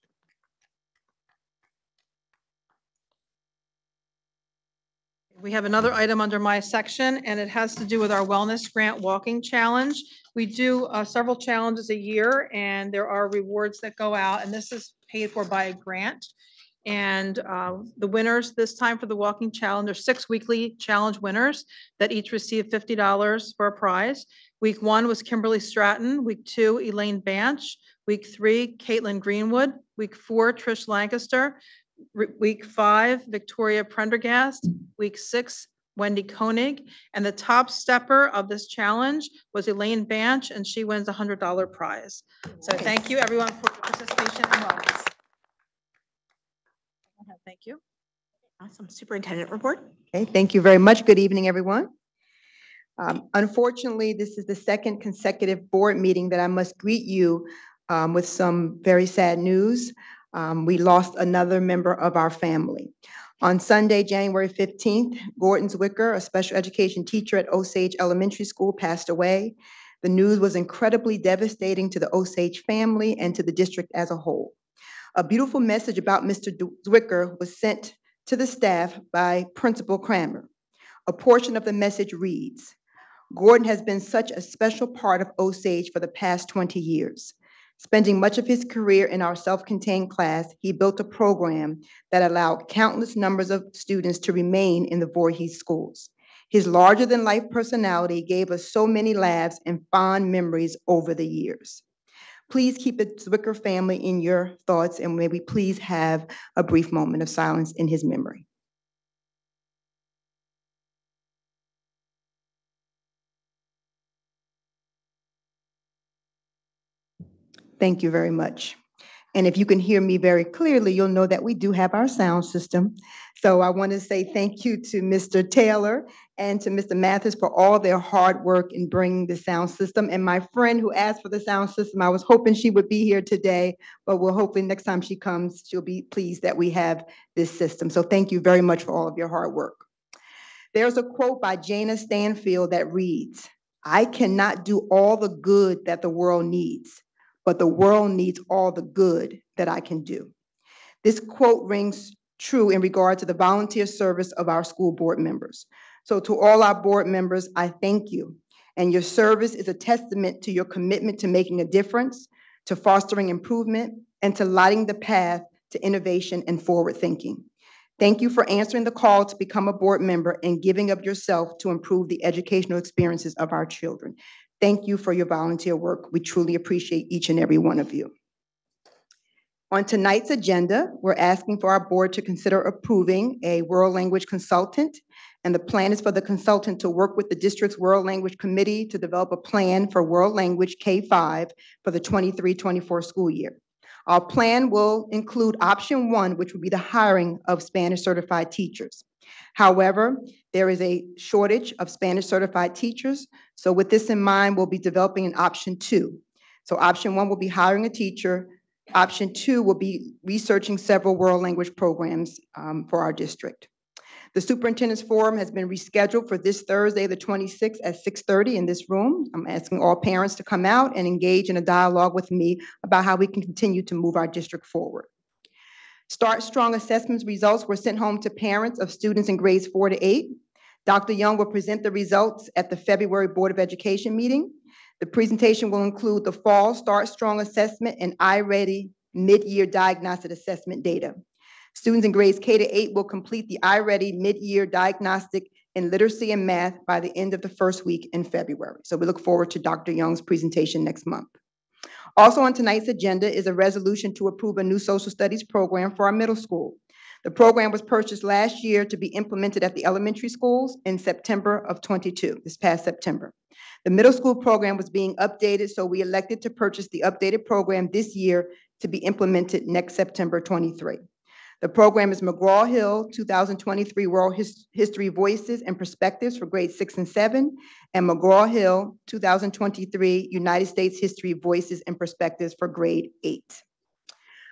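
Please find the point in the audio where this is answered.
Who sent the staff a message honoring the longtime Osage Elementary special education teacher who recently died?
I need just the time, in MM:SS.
01:19.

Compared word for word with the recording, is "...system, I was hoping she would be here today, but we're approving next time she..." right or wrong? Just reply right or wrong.
wrong.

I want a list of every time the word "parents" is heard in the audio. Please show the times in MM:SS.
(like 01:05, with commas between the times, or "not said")
03:39, 03:48.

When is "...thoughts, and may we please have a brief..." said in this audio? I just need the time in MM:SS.
01:44.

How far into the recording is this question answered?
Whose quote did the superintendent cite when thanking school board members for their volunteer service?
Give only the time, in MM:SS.
02:21.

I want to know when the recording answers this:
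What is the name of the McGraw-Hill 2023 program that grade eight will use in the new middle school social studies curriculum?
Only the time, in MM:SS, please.
04:40.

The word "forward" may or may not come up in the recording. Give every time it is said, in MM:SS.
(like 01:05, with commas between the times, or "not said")
02:46, 03:44, 04:09.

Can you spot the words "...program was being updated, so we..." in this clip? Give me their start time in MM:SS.
04:24.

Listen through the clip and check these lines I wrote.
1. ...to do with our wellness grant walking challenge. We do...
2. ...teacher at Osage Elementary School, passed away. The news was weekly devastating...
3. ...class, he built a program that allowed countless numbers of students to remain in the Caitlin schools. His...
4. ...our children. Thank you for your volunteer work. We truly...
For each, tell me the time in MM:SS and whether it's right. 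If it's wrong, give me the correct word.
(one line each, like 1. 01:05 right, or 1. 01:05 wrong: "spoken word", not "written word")
1. 00:07 right
2. 01:07 wrong: "incredibly", not "weekly"
3. 01:30 wrong: "Voorhees", not "Caitlin"
4. 02:53 right.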